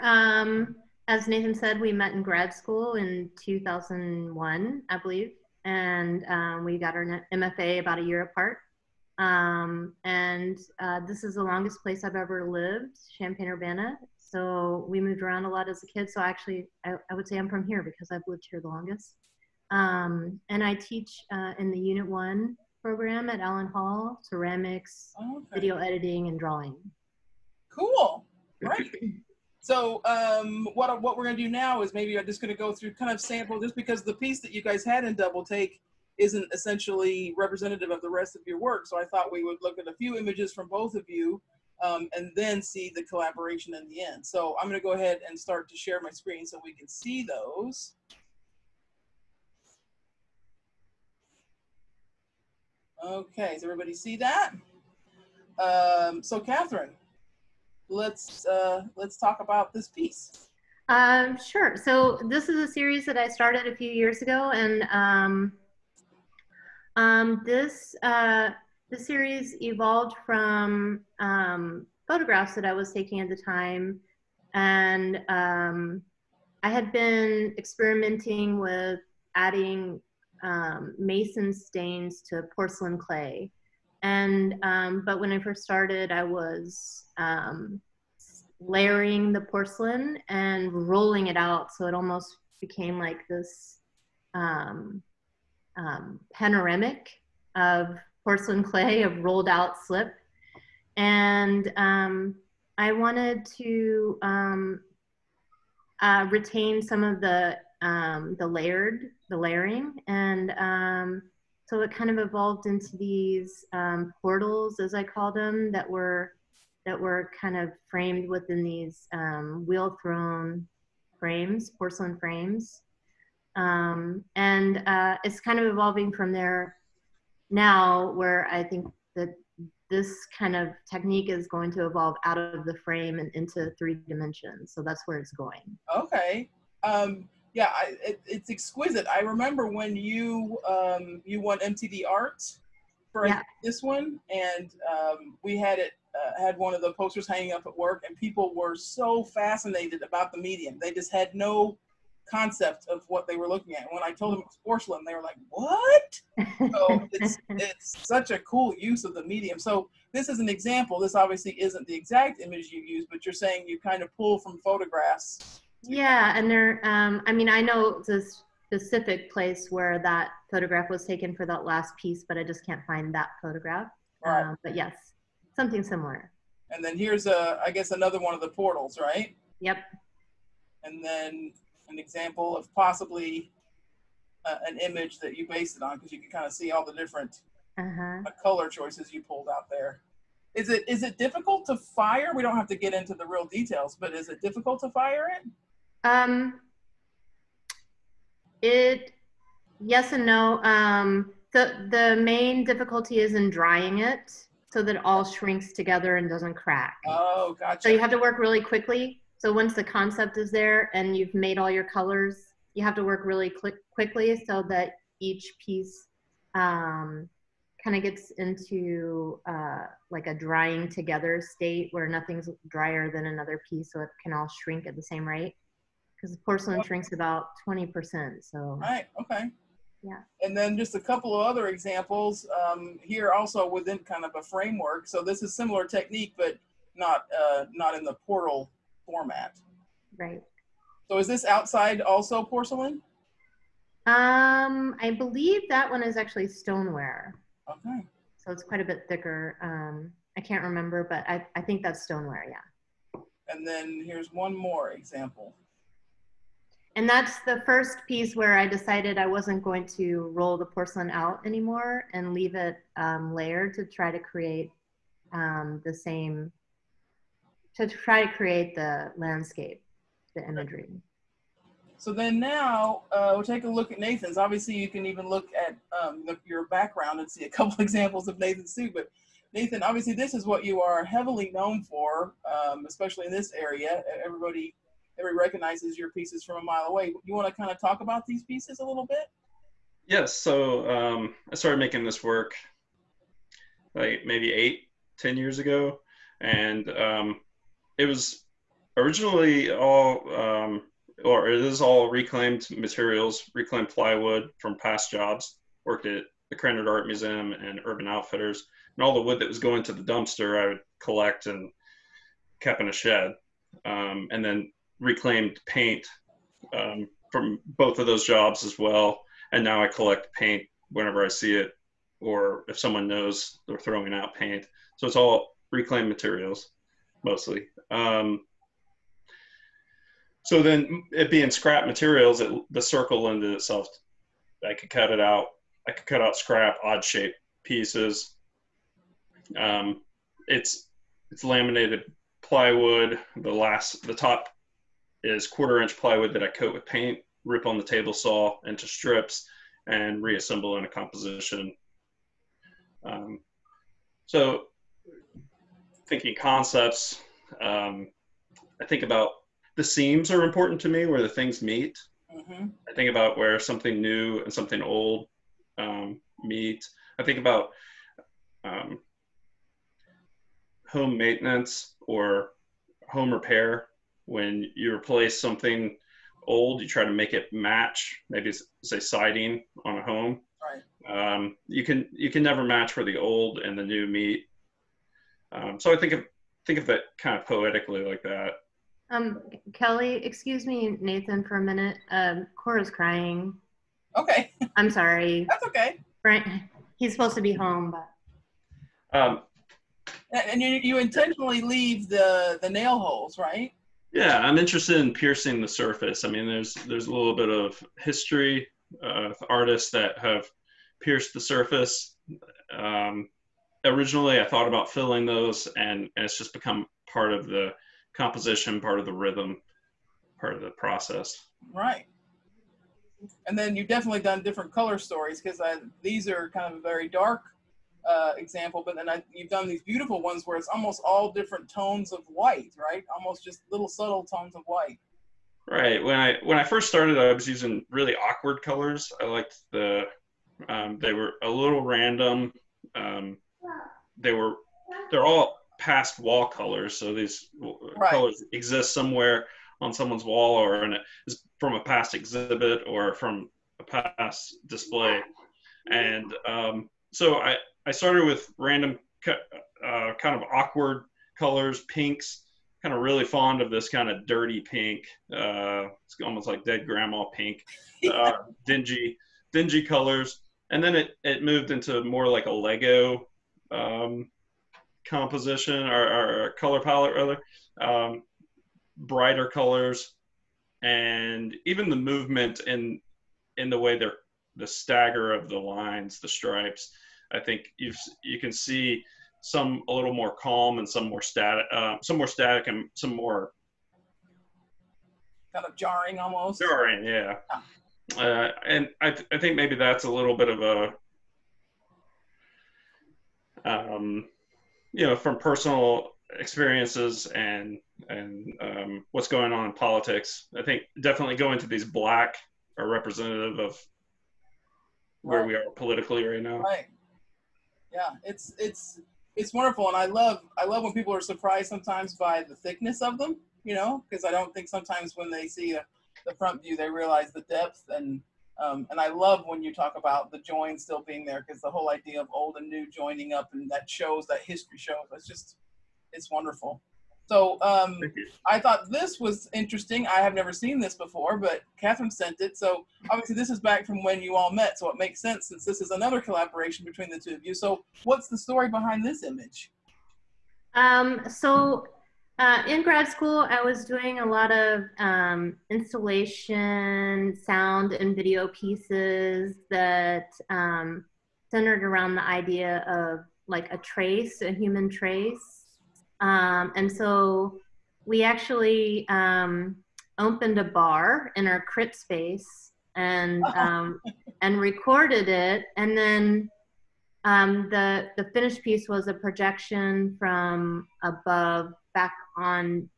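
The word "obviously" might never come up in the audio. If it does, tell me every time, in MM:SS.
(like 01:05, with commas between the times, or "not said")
02:41, 04:34, 04:39, 09:03.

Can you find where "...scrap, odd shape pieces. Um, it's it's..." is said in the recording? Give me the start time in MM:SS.
05:36.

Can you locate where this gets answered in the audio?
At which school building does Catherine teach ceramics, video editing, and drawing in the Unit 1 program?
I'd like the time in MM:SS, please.
00:23.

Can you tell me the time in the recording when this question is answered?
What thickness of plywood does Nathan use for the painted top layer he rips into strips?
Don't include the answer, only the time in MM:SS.
05:45.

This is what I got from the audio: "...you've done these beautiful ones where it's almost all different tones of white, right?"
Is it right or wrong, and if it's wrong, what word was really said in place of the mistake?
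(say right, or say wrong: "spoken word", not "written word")
right.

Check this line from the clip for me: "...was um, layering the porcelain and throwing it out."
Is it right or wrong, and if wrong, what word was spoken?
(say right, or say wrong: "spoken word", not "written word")
wrong: "rolling", not "throwing".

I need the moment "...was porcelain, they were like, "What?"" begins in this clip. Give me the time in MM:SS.
02:34.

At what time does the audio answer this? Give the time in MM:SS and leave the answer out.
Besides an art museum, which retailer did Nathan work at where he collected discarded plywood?
05:07.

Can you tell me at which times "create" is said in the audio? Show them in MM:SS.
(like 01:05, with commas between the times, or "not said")
04:24, 04:28.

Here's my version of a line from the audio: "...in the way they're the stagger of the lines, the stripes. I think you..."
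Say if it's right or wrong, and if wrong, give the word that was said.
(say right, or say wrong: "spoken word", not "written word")
right.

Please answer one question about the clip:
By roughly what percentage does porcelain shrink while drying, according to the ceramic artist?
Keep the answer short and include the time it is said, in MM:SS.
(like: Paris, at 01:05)
20%, at 03:47.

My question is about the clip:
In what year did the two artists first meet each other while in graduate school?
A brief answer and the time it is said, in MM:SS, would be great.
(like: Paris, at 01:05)
2001, at 00:03.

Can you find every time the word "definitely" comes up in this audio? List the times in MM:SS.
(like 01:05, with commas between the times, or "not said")
07:03, 08:31.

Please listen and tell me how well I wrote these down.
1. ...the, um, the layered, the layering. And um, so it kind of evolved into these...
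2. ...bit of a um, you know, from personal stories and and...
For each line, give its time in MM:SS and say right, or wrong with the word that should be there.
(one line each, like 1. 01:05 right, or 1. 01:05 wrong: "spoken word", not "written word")
1. 01:47 right
2. 08:20 wrong: "experiences", not "stories".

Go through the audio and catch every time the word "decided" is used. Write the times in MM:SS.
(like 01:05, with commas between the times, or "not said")
04:18.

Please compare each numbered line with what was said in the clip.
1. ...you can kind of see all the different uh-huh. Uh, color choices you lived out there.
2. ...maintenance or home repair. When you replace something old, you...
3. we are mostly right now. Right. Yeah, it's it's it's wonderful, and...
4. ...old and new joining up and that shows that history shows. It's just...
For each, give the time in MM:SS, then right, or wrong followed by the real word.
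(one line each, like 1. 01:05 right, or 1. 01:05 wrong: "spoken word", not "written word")
1. 03:06 wrong: "pulled", not "lived"
2. 06:11 right
3. 08:35 wrong: "politically", not "mostly"
4. 08:52 right.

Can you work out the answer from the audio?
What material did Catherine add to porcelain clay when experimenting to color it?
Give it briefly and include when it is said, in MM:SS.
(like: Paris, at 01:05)
mason stains, at 01:20.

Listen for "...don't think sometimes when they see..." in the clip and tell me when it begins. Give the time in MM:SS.
08:44.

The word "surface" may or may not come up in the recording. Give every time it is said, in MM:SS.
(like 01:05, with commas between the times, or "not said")
06:45, 06:51.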